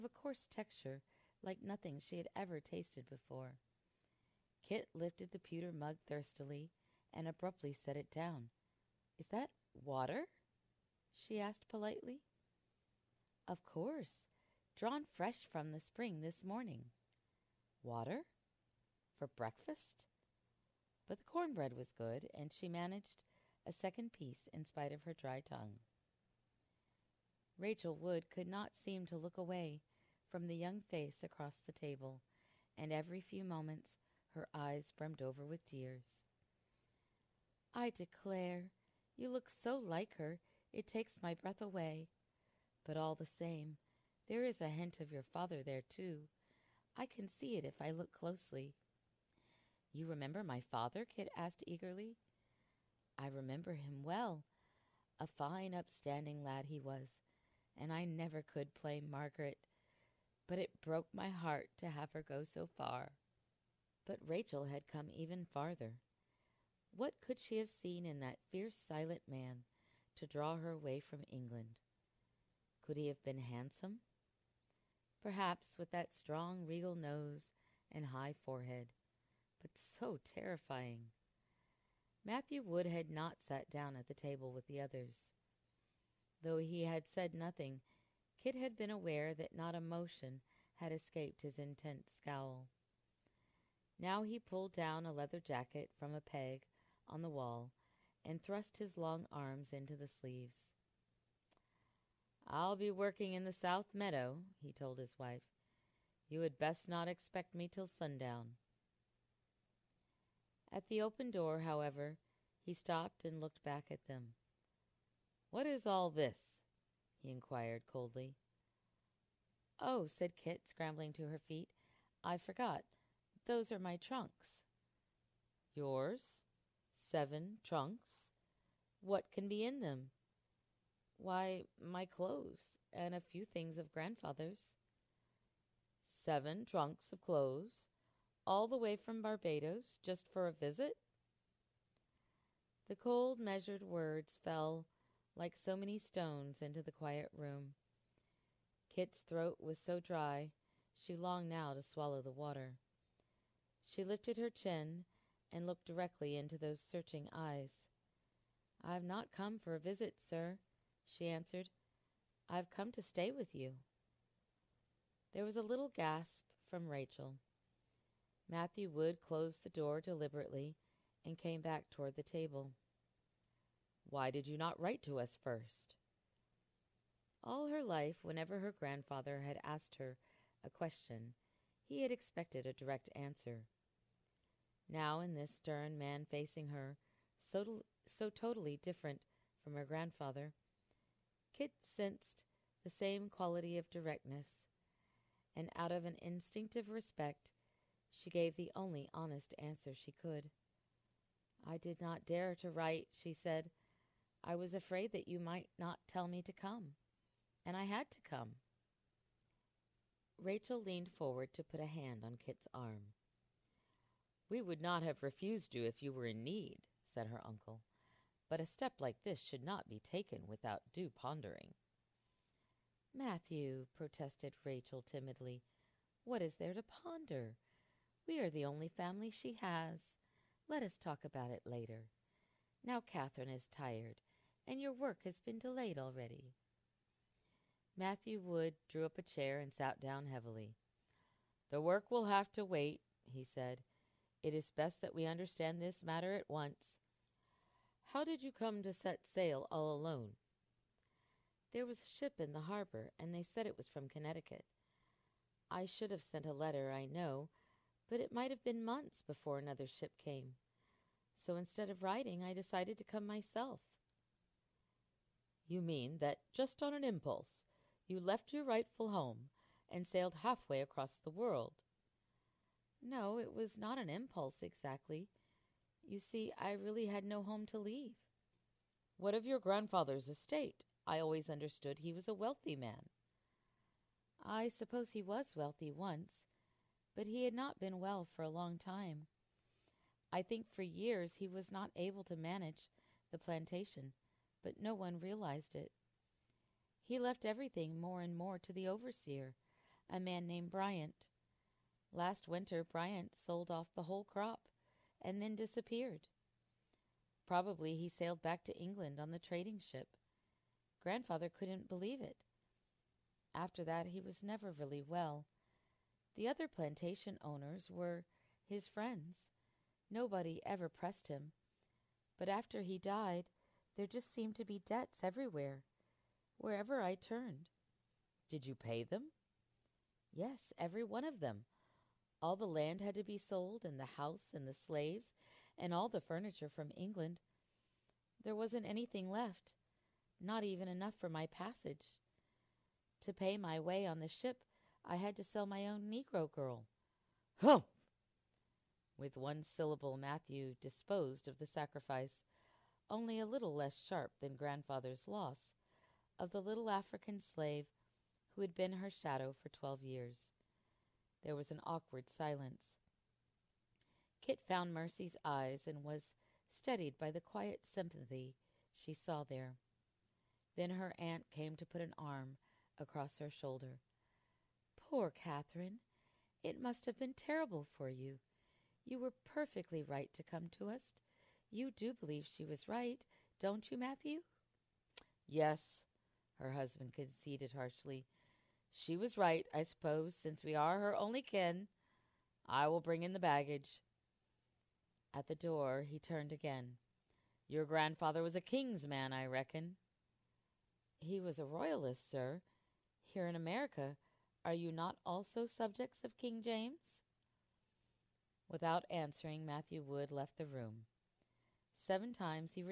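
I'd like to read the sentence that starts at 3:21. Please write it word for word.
I did not dare to write, she said.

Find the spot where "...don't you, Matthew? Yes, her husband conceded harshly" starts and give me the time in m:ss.
6:23.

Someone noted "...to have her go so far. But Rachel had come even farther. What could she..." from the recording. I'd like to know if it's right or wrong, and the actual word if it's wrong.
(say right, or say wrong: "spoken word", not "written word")
right.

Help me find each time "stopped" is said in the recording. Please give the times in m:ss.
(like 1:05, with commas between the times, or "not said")
1:52.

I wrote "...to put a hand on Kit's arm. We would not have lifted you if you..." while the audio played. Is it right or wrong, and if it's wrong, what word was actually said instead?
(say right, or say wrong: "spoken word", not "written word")
wrong: "refused", not "lifted".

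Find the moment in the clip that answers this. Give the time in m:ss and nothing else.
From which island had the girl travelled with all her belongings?
2:19.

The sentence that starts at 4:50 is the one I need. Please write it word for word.
I think for years he was not able to manage the plantation but no one realized it.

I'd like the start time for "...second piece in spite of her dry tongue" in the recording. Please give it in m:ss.
0:23.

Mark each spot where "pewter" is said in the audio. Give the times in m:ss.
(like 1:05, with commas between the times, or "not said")
0:05.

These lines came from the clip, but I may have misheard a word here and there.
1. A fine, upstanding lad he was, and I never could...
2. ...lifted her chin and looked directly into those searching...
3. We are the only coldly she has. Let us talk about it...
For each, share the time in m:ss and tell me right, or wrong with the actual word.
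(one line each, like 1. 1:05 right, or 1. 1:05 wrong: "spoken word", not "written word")
1. 0:55 right
2. 2:34 right
3. 3:48 wrong: "family", not "coldly".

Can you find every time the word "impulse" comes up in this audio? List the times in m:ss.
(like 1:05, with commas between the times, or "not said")
4:27, 4:34.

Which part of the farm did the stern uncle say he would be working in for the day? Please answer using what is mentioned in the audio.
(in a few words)
South Meadow.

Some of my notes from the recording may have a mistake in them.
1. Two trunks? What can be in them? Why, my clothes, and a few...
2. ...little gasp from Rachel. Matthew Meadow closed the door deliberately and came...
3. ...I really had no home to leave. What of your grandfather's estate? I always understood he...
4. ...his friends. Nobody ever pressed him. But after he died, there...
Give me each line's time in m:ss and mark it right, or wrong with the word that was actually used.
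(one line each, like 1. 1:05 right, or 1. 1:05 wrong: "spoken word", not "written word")
1. 2:06 wrong: "Seven", not "Two"
2. 2:45 wrong: "Wood", not "Meadow"
3. 4:36 right
4. 5:18 right.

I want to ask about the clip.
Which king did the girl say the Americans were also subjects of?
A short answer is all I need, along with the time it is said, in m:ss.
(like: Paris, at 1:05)
King James, at 6:46.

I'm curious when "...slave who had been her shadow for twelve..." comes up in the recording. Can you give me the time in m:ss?
5:57.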